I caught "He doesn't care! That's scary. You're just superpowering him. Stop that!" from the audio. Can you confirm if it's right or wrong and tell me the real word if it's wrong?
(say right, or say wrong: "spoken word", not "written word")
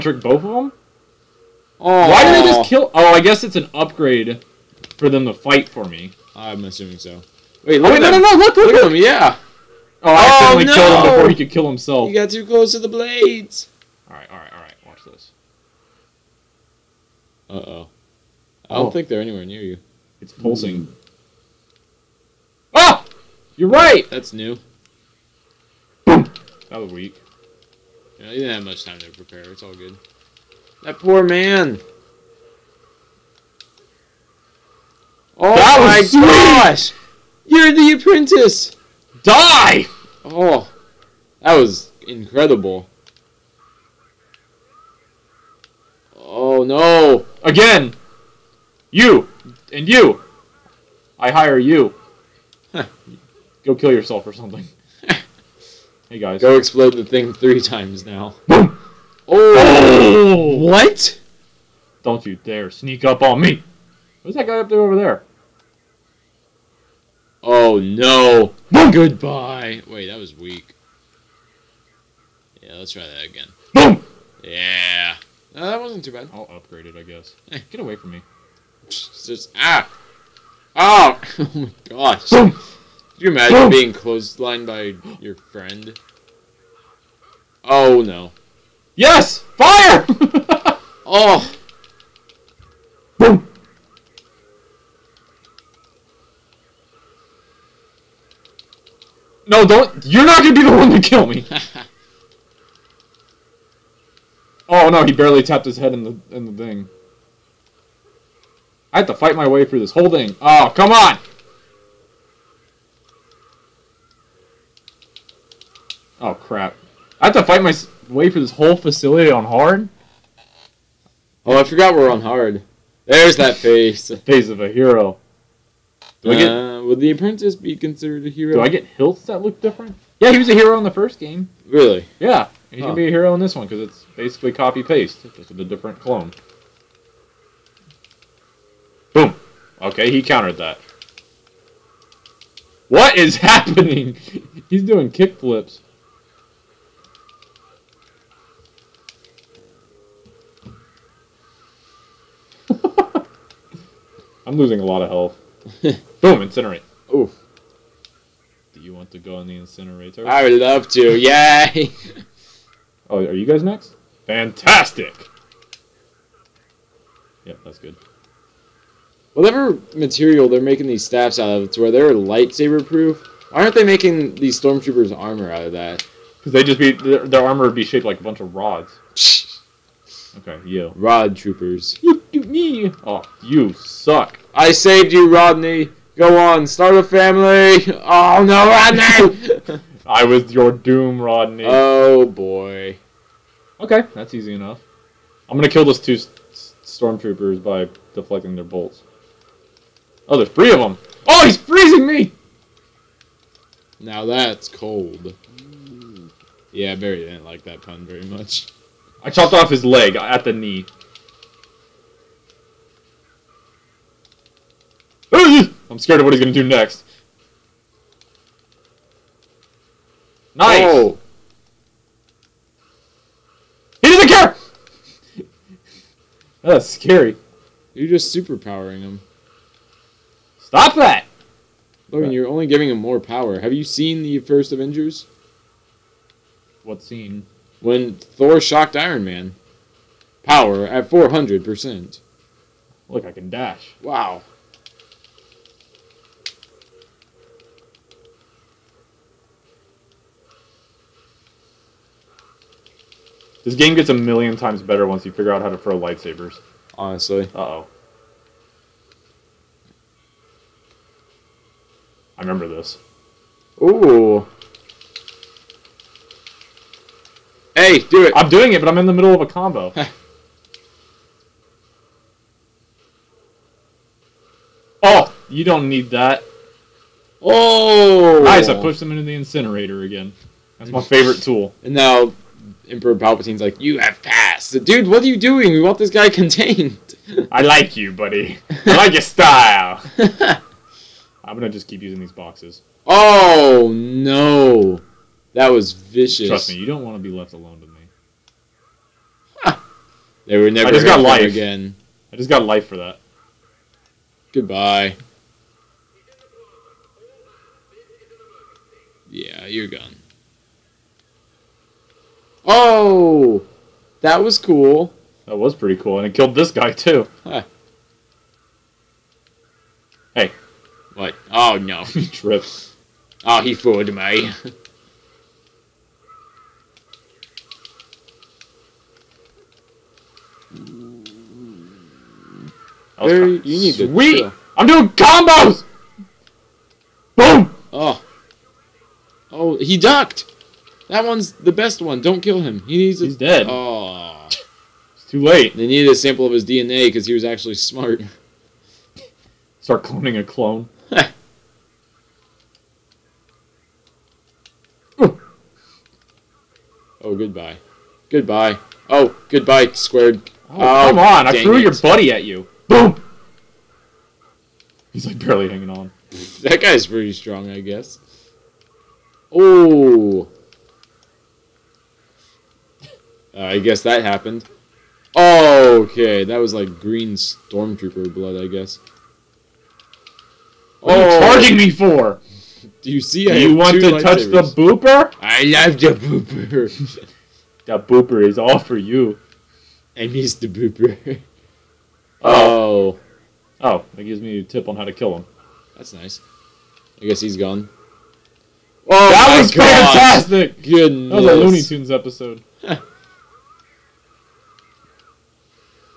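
right.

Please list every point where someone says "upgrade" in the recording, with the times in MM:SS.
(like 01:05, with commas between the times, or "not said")
00:03, 01:16.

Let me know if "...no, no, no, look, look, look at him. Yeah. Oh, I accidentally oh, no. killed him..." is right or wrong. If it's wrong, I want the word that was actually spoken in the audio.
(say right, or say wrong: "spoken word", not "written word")
right.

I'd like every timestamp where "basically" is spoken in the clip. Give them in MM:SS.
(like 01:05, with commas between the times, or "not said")
02:14.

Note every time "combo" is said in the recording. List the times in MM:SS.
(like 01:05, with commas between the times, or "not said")
04:29, 05:35.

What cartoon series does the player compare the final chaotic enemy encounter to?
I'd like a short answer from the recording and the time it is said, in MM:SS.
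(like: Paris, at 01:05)
Looney Tunes, at 06:41.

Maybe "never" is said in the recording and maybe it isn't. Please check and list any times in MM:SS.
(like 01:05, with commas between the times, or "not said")
05:00.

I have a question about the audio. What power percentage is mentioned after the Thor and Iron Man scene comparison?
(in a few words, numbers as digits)
400%.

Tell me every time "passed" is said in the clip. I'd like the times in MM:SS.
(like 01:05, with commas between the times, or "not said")
04:44.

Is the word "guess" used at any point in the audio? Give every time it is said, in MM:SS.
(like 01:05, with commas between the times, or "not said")
00:03, 01:17, 06:07, 06:13, 06:18, 06:37.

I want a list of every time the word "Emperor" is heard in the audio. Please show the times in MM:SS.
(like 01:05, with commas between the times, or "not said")
04:42.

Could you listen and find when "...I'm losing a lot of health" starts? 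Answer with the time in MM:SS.
02:34.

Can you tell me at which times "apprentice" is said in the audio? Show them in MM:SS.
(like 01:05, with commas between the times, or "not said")
00:37, 02:07.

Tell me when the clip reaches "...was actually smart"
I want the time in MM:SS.
05:47.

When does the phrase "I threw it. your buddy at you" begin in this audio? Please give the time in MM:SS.
06:01.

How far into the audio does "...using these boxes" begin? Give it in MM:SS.
04:52.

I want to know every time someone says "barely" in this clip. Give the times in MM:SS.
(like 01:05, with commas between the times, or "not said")
01:45, 06:05.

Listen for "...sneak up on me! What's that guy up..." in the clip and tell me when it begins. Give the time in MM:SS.
01:02.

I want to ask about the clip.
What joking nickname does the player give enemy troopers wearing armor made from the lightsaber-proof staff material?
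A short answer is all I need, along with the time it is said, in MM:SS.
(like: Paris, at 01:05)
Rod troopers, at 03:00.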